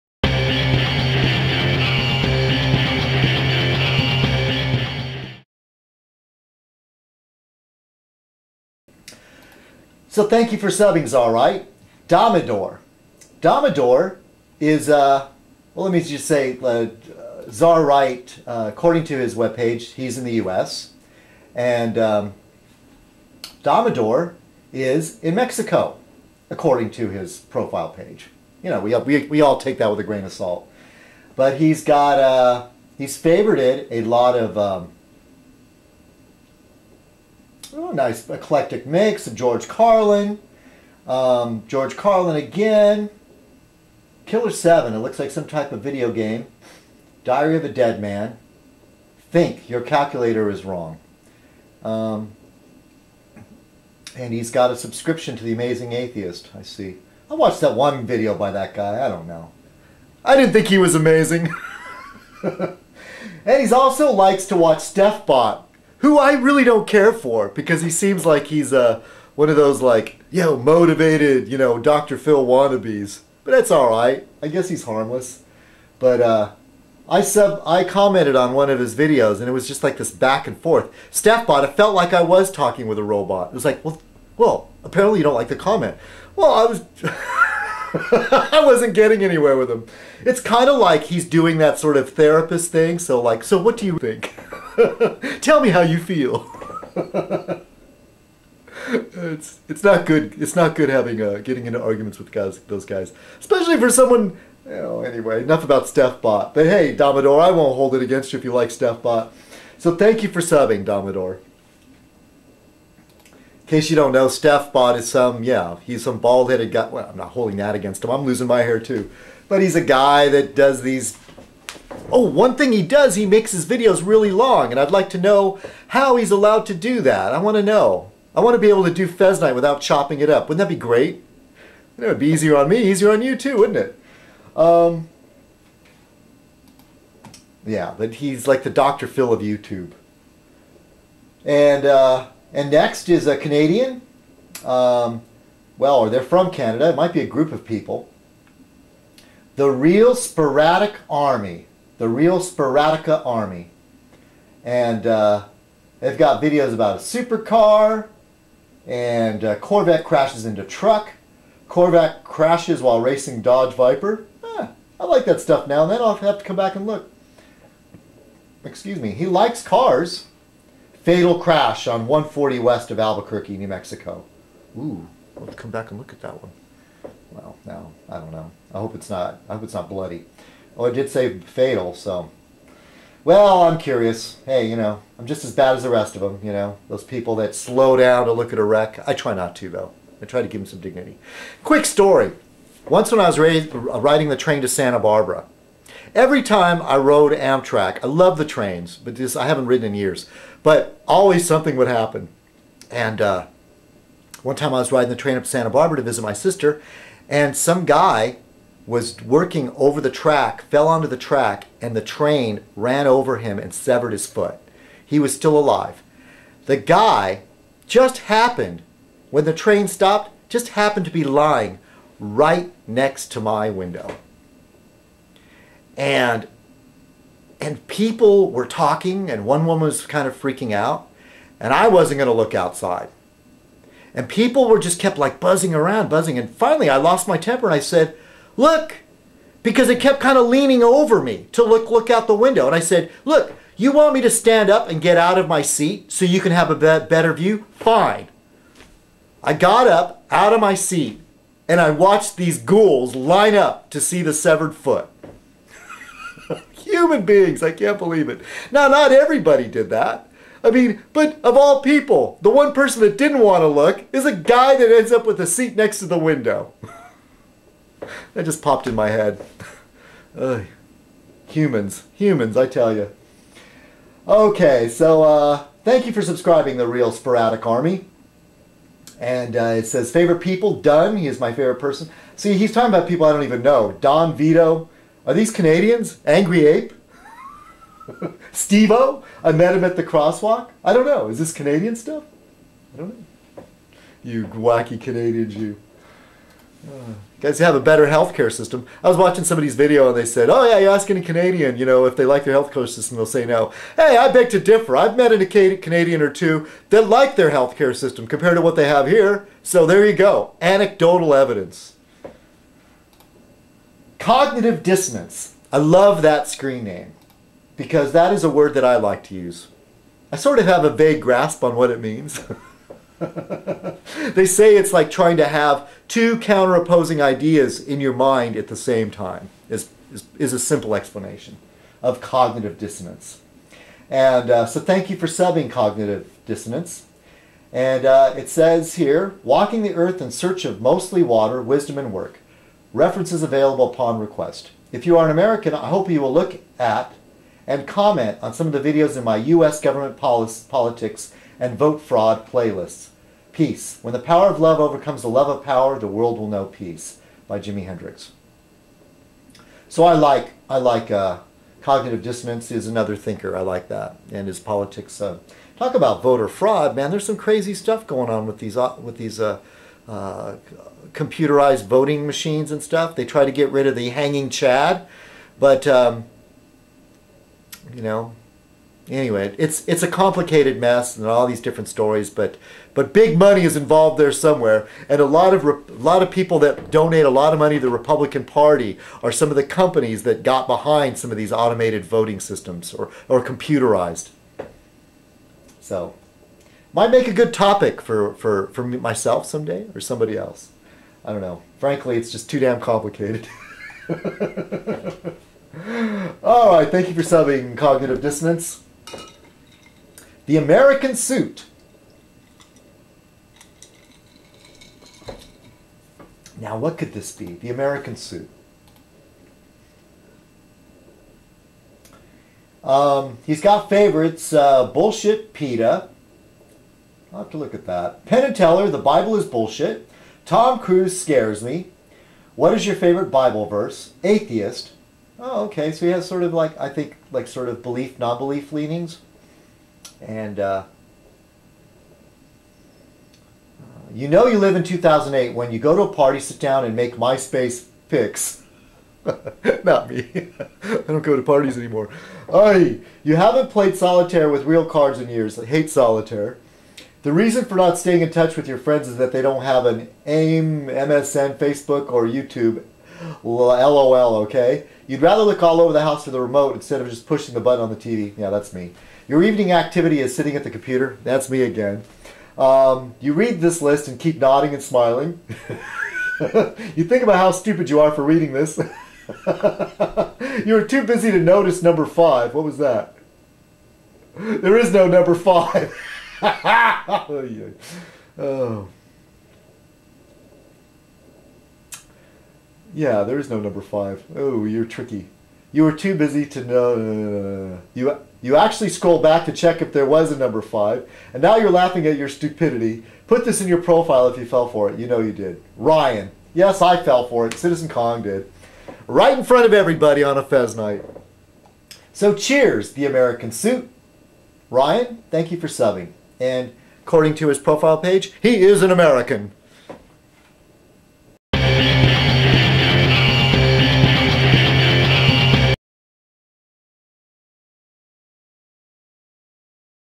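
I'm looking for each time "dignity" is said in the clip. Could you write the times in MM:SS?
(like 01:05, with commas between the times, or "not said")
03:10.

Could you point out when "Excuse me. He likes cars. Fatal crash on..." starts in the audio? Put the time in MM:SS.
02:48.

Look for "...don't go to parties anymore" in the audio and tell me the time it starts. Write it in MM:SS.
07:31.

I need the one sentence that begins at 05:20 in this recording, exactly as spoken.
I sort of have a vague grasp on what it means.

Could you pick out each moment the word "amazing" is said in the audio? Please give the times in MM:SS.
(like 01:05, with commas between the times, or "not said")
00:55, 01:00.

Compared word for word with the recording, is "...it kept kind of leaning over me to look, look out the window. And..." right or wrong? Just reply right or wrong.
right.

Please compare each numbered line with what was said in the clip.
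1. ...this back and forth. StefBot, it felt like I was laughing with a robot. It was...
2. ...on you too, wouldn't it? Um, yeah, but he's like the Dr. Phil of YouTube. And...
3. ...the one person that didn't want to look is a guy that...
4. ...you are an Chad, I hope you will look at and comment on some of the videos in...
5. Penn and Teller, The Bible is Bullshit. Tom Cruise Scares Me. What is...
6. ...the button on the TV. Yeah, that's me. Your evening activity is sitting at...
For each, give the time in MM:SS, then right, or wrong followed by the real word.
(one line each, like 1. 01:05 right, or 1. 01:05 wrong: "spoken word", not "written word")
1. 01:19 wrong: "talking", not "laughing"
2. 02:13 right
3. 04:22 right
4. 05:45 wrong: "American", not "Chad"
5. 07:08 right
6. 07:47 right.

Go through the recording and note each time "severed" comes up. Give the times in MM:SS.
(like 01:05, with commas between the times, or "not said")
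03:33, 04:14.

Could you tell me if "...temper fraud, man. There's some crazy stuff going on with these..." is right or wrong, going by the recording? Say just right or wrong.
wrong.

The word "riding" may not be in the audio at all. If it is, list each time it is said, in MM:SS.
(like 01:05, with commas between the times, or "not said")
03:13, 03:24.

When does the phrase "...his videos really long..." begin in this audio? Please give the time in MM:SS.
02:03.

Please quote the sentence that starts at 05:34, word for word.
And uh, so thank you for subbing cognitive dissonance.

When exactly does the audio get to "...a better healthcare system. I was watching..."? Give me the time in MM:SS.
04:57.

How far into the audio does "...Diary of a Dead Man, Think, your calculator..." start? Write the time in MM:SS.
00:47.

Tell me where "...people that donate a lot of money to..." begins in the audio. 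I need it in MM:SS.
06:26.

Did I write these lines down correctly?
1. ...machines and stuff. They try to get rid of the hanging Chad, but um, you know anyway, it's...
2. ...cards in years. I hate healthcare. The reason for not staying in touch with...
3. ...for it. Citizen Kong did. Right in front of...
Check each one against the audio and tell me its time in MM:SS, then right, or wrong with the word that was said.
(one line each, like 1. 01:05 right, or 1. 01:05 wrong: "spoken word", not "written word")
1. 06:12 right
2. 07:34 wrong: "solitaire", not "healthcare"
3. 08:27 right.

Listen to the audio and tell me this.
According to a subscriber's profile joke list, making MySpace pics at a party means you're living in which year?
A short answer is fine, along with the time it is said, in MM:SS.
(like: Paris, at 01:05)
2008, at 07:24.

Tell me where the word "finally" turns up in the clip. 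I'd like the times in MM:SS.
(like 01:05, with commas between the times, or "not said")
03:56.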